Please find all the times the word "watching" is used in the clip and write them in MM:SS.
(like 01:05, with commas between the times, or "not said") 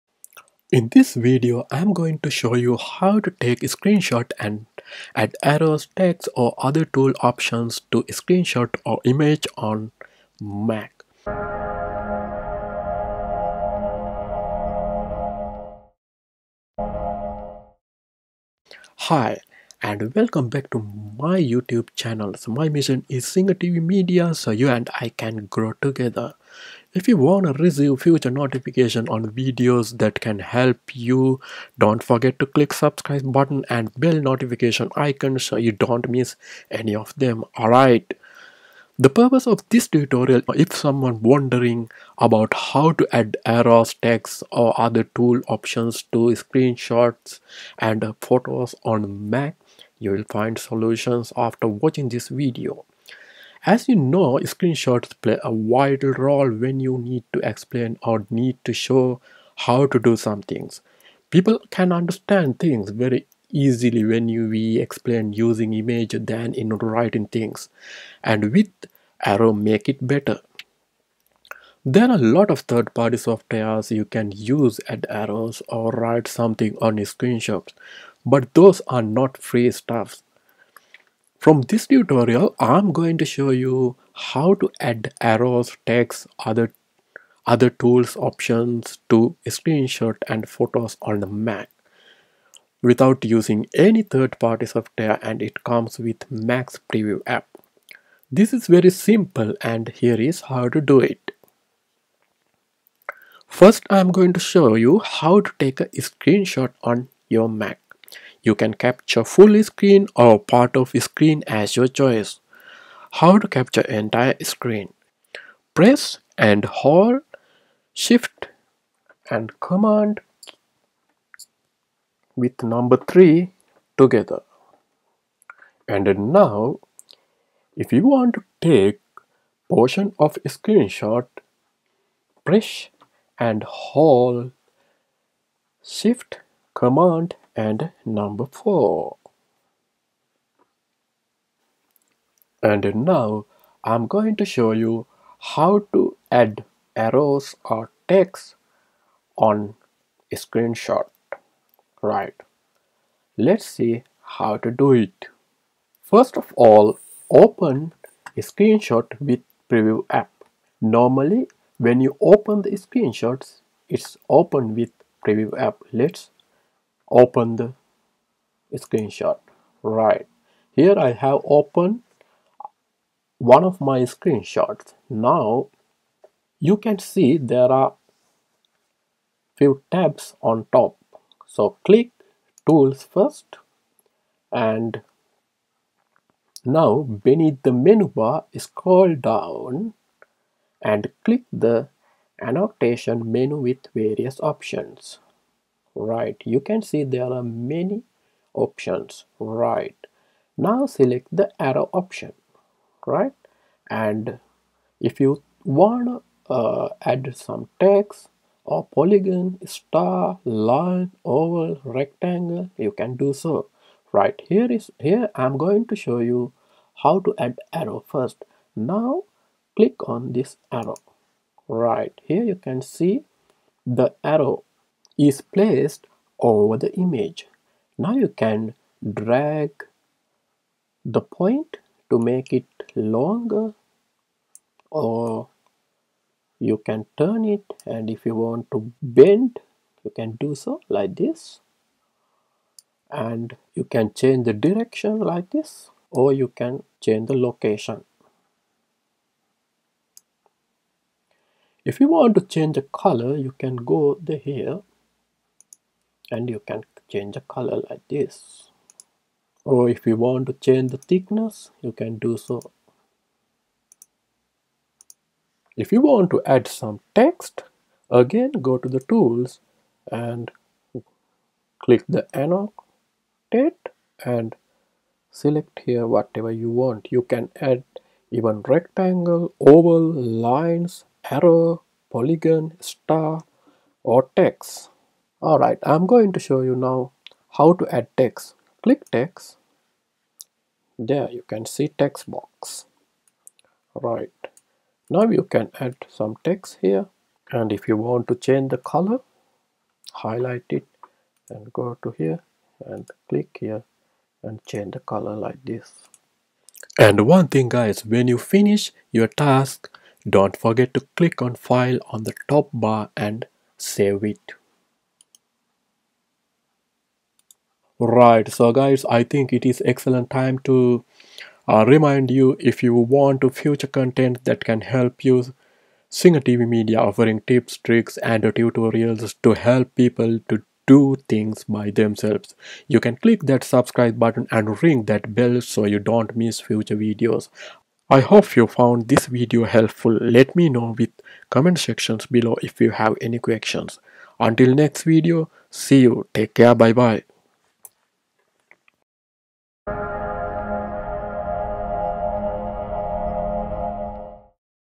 00:51.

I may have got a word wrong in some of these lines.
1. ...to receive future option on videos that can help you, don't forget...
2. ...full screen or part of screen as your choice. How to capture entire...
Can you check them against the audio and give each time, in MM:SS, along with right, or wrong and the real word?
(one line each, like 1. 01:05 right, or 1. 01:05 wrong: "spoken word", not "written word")
1. 00:27 wrong: "notification", not "option"
2. 01:49 right.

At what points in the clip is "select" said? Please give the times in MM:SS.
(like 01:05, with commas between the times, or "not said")
03:20, 04:35.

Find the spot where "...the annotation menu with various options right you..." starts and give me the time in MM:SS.
03:11.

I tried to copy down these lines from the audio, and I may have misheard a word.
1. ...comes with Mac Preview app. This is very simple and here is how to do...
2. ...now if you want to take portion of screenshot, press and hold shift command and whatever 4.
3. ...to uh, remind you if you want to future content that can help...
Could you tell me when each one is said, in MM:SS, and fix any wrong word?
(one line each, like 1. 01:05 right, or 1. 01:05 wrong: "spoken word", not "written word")
1. 01:35 right
2. 02:06 wrong: "number", not "whatever"
3. 05:20 right.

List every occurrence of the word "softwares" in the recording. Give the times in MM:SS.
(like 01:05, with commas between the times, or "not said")
01:13, 01:34.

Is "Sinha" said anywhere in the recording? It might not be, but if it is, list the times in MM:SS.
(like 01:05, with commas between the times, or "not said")
00:23.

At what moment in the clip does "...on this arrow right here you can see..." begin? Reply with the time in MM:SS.
03:40.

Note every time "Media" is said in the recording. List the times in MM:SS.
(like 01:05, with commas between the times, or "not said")
00:23, 05:26.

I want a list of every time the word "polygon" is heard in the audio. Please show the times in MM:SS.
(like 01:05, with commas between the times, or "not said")
03:28, 04:42.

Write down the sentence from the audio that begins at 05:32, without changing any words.
You can click that subscribe button and ring that bell so you don't miss future videos.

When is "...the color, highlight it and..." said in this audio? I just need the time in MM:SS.
04:58.